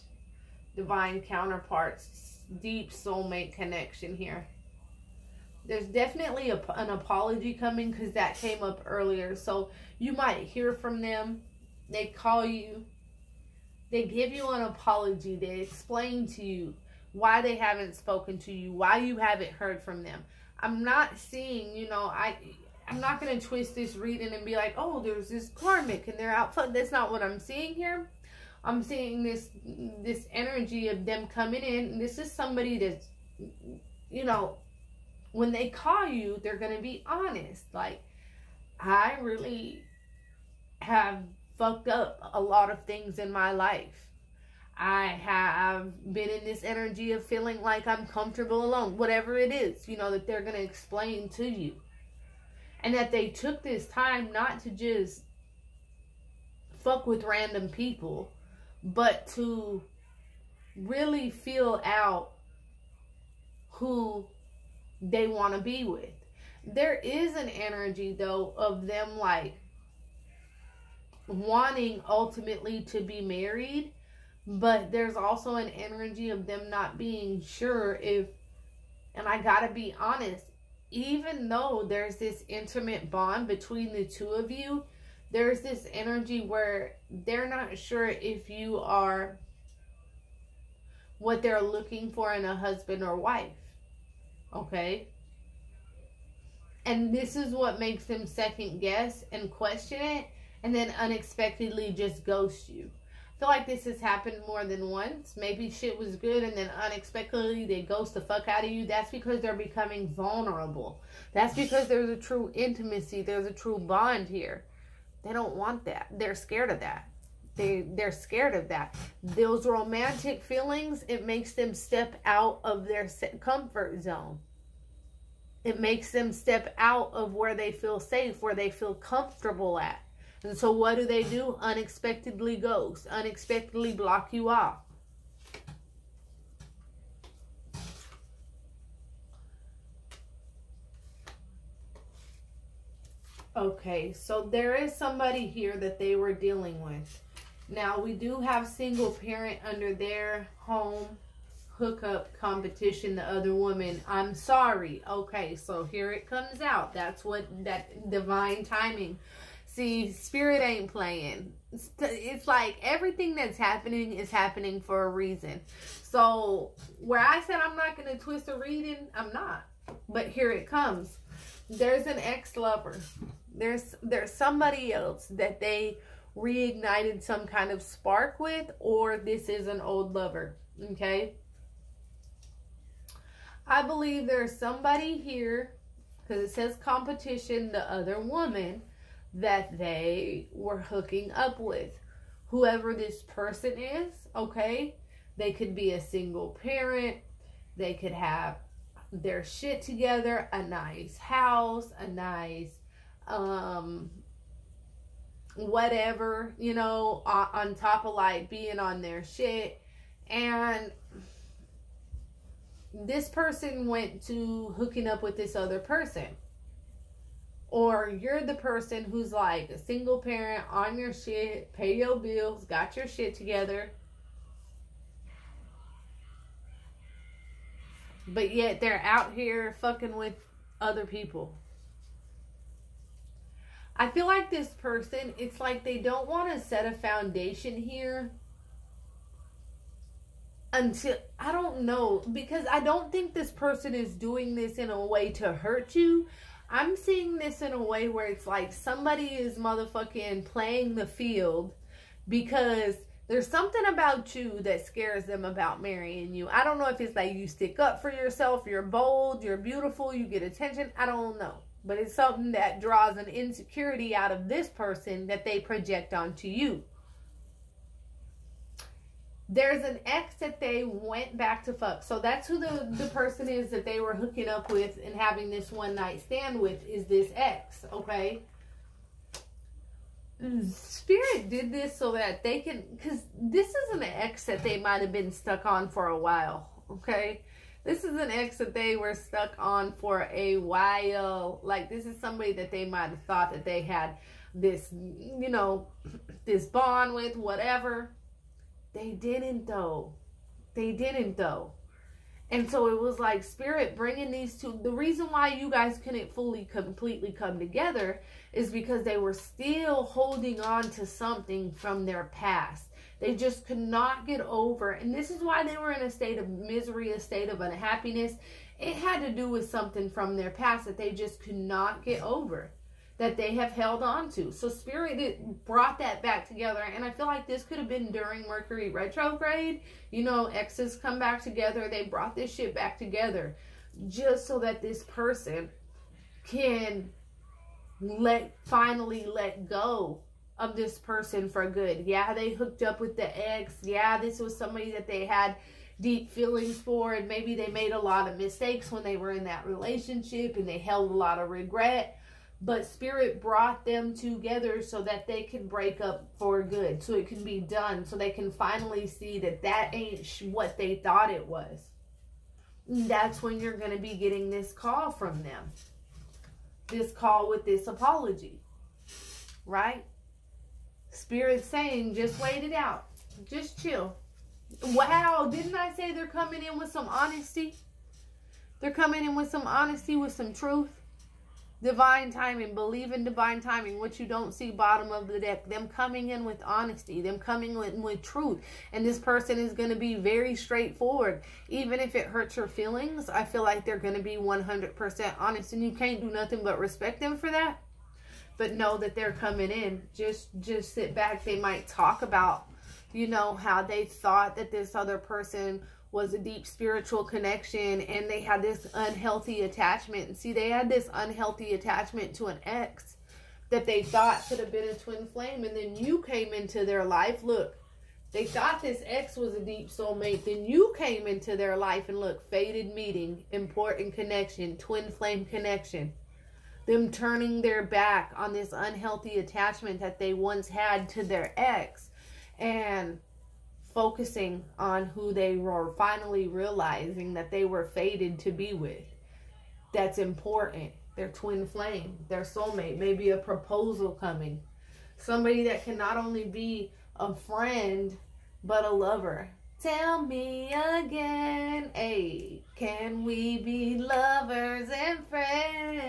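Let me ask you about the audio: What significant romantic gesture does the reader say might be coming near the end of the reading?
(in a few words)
A proposal.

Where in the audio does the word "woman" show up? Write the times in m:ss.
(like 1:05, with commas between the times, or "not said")
2:33, 3:08.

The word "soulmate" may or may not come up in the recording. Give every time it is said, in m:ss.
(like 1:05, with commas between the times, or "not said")
0:02, 6:59, 7:22.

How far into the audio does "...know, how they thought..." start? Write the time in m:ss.
6:43.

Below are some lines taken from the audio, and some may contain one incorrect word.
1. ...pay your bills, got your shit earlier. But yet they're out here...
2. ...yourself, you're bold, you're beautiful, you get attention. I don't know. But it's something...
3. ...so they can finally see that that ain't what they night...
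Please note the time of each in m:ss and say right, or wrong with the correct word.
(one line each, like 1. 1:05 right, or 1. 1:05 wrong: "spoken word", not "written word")
1. 3:41 wrong: "together", not "earlier"
2. 4:18 right
3. 5:58 wrong: "thought", not "night".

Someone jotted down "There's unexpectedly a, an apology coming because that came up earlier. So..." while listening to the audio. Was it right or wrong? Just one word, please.
wrong.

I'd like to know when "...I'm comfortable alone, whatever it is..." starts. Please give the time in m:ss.
0:47.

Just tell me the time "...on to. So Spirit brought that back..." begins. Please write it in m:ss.
5:24.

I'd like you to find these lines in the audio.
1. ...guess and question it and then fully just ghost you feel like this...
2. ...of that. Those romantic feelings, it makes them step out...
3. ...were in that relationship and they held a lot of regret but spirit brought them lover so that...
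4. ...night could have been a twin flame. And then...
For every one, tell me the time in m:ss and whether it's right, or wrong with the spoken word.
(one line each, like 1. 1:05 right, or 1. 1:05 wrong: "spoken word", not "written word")
1. 1:38 wrong: "unexpectedly", not "fully"
2. 1:58 right
3. 5:49 wrong: "together", not "lover"
4. 6:54 wrong: "thought", not "night".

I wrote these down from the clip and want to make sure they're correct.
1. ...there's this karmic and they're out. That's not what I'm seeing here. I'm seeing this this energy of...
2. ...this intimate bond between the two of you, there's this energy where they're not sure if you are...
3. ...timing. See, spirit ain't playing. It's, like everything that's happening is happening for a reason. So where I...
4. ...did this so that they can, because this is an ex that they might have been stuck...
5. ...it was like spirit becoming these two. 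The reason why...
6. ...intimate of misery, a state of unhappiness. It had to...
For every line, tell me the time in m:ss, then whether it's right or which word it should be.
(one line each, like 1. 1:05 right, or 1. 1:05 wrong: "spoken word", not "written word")
1. 0:25 right
2. 1:22 right
3. 2:38 right
4. 4:41 right
5. 5:02 wrong: "bringing", not "becoming"
6. 5:16 wrong: "state", not "intimate".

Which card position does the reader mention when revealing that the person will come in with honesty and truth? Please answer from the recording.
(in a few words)
Bottom of the deck.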